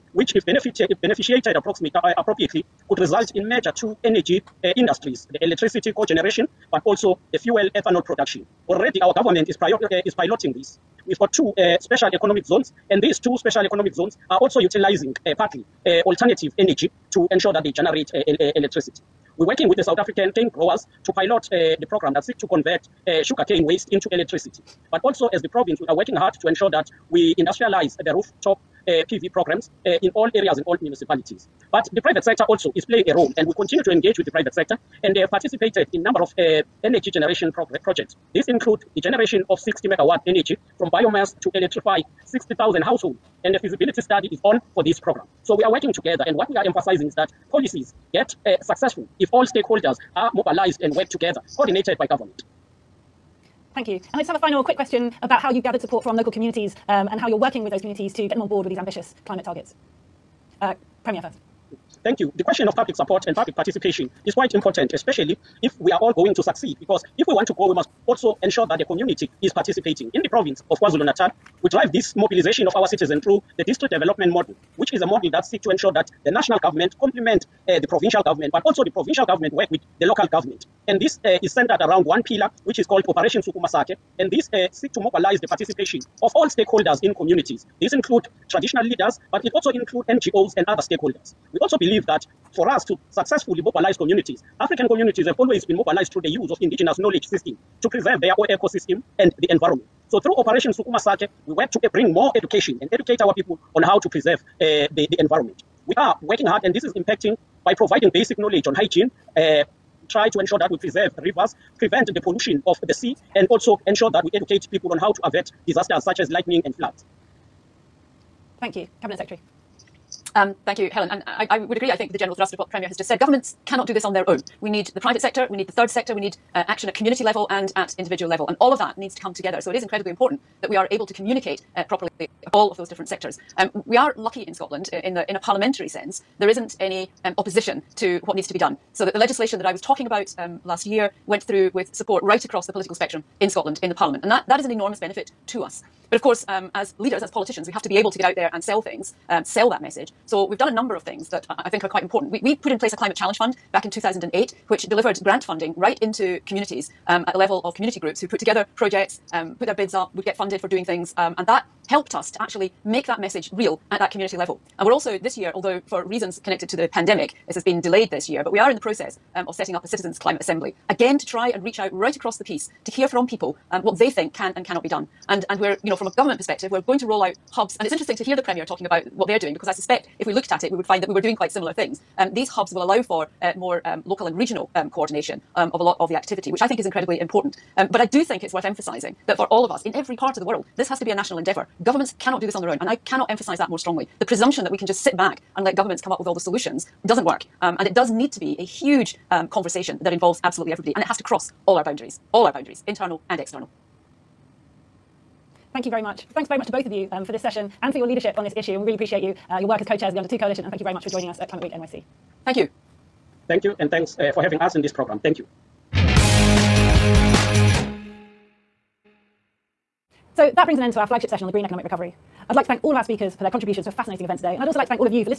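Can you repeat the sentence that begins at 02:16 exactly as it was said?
There isn't any um, opposition to what needs to be done.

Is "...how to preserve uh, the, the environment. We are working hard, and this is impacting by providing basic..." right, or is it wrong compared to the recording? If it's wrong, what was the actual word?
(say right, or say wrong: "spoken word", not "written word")
right.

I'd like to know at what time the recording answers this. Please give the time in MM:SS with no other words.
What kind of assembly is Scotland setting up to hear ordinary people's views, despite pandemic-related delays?
02:49.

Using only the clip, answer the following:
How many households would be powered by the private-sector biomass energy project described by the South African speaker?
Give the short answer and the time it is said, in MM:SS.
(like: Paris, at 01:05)
60,000, at 00:42.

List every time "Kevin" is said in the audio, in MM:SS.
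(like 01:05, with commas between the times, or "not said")
not said.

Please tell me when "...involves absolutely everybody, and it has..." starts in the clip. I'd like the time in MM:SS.
03:20.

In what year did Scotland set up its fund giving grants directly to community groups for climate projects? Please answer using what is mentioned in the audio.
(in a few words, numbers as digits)
2008.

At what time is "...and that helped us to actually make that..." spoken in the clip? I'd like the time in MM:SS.
02:41.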